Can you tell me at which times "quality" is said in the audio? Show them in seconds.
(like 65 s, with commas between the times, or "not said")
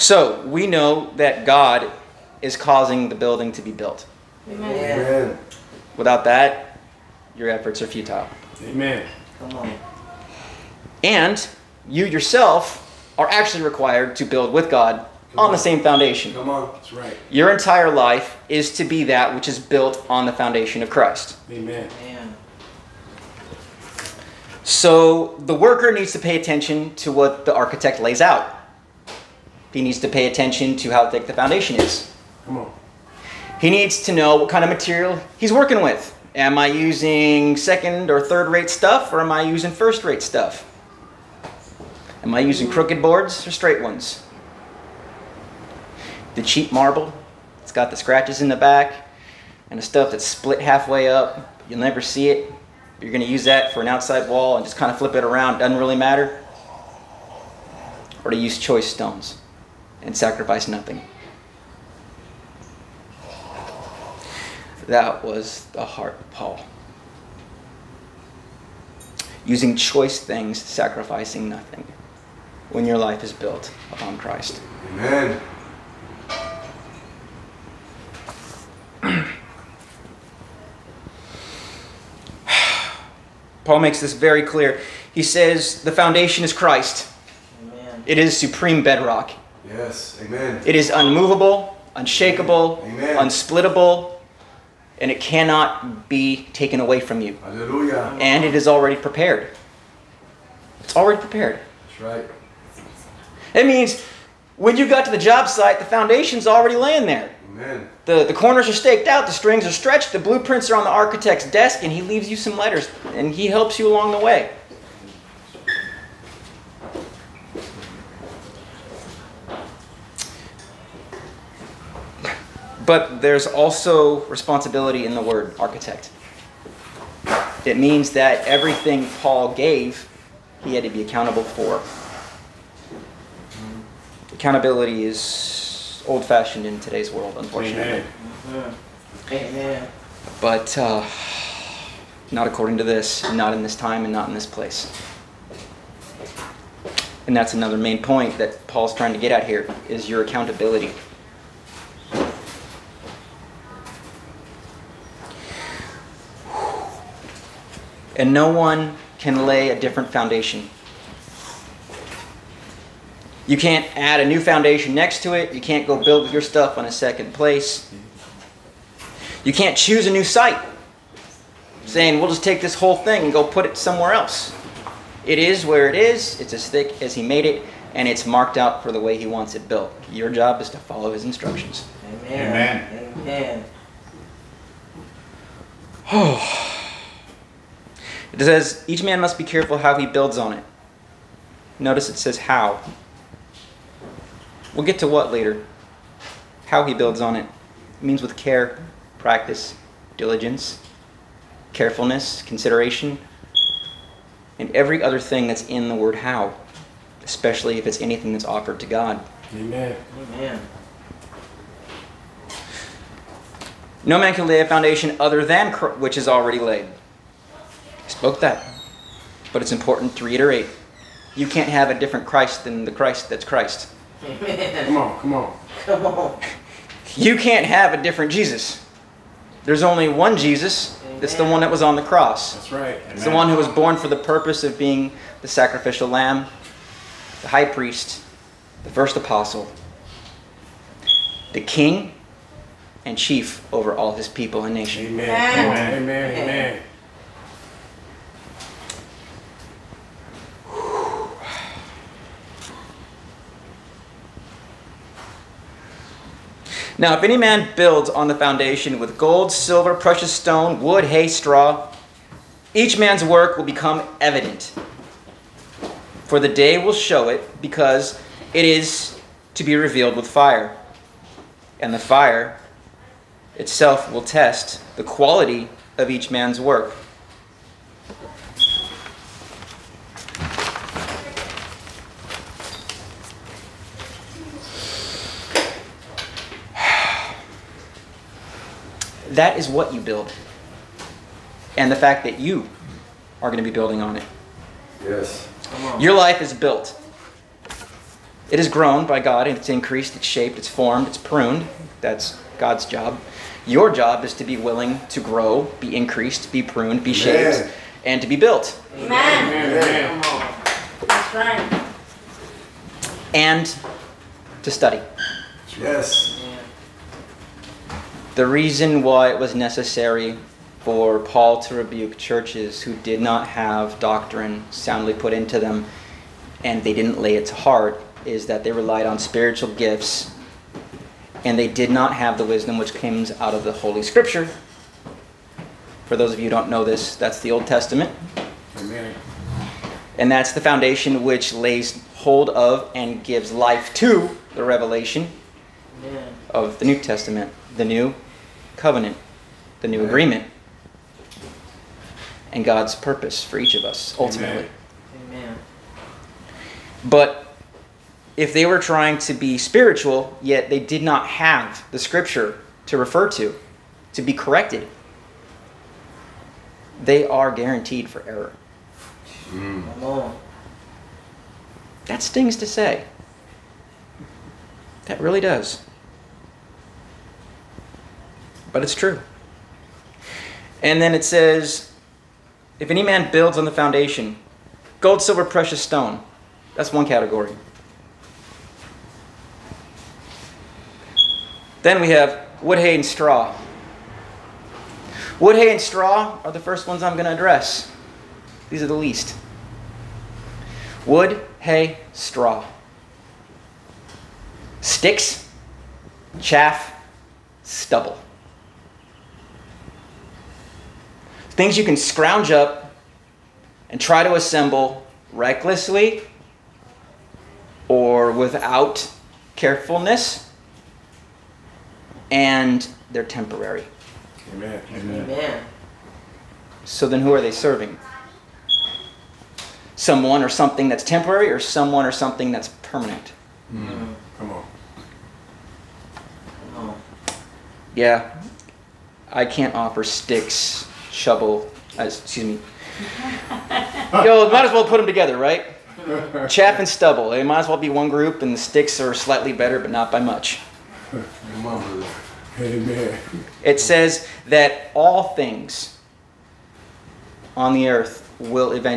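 275 s.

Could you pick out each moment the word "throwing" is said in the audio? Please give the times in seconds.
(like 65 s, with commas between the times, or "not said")
not said.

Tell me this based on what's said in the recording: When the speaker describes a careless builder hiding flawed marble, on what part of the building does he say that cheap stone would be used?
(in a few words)
An outside wall.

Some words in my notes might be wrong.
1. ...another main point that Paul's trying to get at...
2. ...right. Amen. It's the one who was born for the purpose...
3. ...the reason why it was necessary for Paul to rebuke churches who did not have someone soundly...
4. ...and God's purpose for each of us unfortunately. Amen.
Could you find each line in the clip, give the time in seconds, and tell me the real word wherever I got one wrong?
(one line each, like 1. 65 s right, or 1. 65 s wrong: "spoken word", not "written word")
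1. 147 s right
2. 232 s right
3. 318 s wrong: "doctrine", not "someone"
4. 352 s wrong: "ultimately", not "unfortunately".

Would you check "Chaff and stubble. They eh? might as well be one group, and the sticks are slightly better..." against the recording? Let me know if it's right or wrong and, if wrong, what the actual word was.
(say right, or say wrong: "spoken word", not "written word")
right.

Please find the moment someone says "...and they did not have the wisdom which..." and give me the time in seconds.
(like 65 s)
331 s.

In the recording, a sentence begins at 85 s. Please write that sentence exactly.
He says the foundation is Christ.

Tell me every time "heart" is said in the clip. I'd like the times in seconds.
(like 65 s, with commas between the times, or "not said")
65 s, 327 s.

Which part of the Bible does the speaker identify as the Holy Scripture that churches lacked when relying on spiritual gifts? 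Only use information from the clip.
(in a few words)
The Old Testament.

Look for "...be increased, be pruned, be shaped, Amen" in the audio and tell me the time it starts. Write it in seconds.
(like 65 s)
305 s.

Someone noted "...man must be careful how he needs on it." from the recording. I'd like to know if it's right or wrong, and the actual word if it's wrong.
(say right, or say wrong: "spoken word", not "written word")
wrong: "builds", not "needs".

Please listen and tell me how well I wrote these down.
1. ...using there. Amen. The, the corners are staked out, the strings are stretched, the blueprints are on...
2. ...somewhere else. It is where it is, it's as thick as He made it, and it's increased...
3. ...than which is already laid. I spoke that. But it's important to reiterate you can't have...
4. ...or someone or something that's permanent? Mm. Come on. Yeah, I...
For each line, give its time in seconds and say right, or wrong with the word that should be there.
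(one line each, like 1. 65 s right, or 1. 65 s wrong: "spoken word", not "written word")
1. 106 s wrong: "laying", not "using"
2. 173 s wrong: "marked", not "increased"
3. 215 s right
4. 431 s right.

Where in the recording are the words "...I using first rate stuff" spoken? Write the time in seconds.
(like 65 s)
39 s.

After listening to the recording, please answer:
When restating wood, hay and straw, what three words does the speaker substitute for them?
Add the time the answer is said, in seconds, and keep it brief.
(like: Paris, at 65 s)
Sticks, chaff, stubble, at 404 s.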